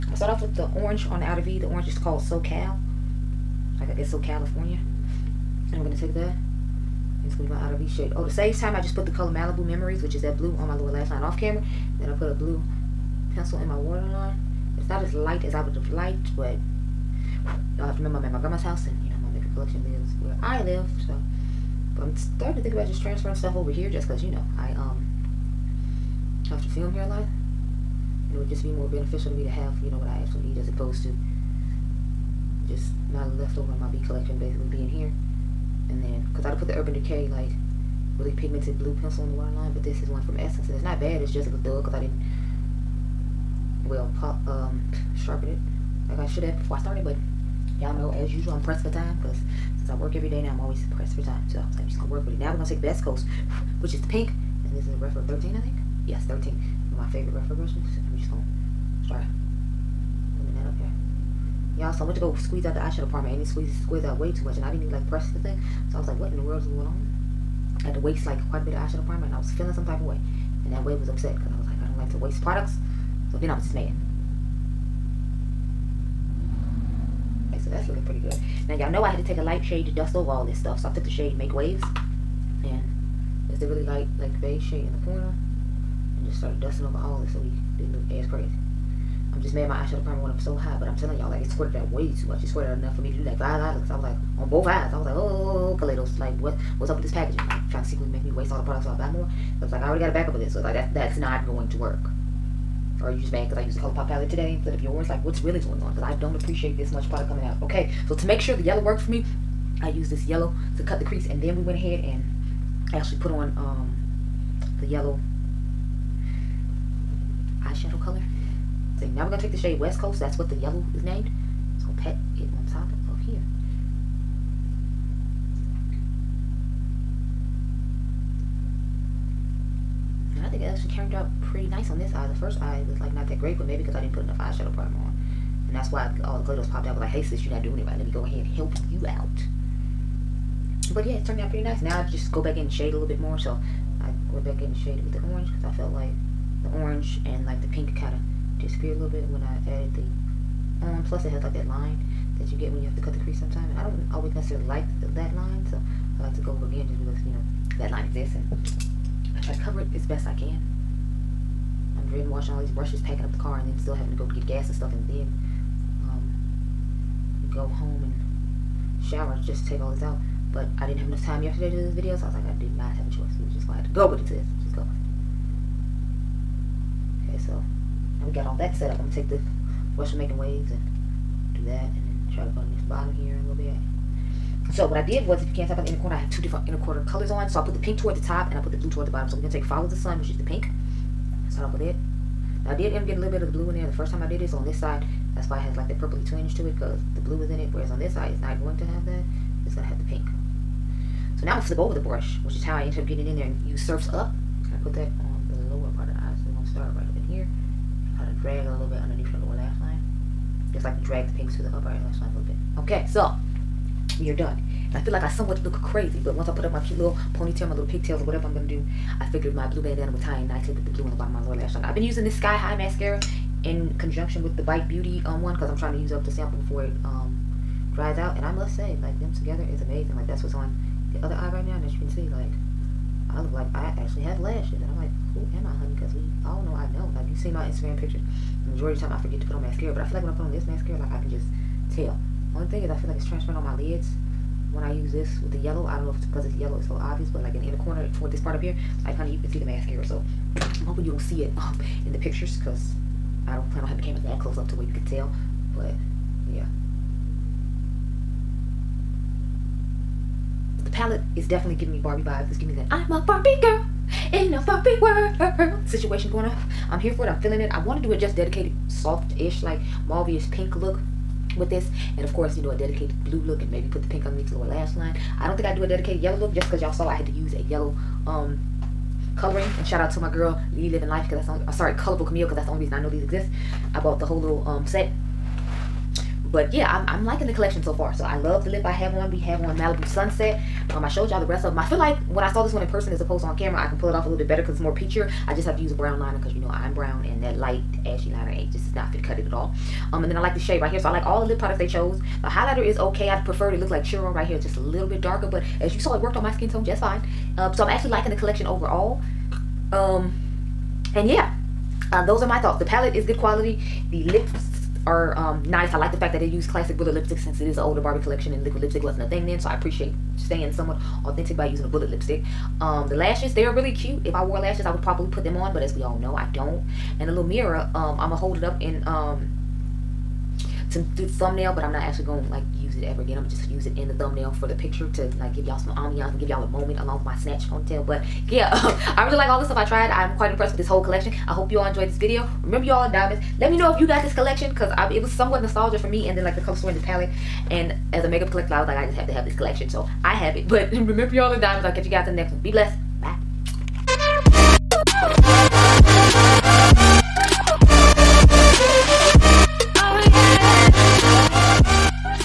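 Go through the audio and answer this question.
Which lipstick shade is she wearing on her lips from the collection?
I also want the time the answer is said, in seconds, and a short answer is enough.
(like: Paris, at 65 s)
Malibu Sunset, at 289 s.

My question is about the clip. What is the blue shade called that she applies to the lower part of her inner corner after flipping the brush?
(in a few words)
Surf's Up.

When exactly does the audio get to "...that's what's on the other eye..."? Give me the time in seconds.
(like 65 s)
230 s.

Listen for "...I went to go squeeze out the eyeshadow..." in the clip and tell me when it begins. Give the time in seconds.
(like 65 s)
62 s.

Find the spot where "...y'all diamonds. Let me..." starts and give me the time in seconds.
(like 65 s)
342 s.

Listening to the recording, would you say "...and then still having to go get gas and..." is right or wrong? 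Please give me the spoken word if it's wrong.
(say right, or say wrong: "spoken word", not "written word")
right.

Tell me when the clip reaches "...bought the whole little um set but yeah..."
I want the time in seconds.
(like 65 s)
283 s.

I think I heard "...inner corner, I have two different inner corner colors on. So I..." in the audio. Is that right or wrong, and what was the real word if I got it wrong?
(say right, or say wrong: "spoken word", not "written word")
right.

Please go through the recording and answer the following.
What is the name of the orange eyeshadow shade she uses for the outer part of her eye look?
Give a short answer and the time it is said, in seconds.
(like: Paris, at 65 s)
SoCal, at 2 s.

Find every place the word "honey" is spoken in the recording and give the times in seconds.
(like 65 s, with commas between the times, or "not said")
235 s, 249 s.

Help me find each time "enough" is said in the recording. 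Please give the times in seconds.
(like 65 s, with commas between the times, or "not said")
92 s, 134 s, 171 s.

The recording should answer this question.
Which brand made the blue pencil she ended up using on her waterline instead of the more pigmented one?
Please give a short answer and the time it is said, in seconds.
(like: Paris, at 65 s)
Essence, at 40 s.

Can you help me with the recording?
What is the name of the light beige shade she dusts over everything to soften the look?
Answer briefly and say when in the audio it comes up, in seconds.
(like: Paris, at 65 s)
Make Waves, at 81 s.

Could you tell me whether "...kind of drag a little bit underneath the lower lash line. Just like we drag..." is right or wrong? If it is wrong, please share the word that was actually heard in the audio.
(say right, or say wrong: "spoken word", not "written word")
right.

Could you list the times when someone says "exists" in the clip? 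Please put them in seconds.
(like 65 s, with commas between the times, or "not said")
158 s, 283 s.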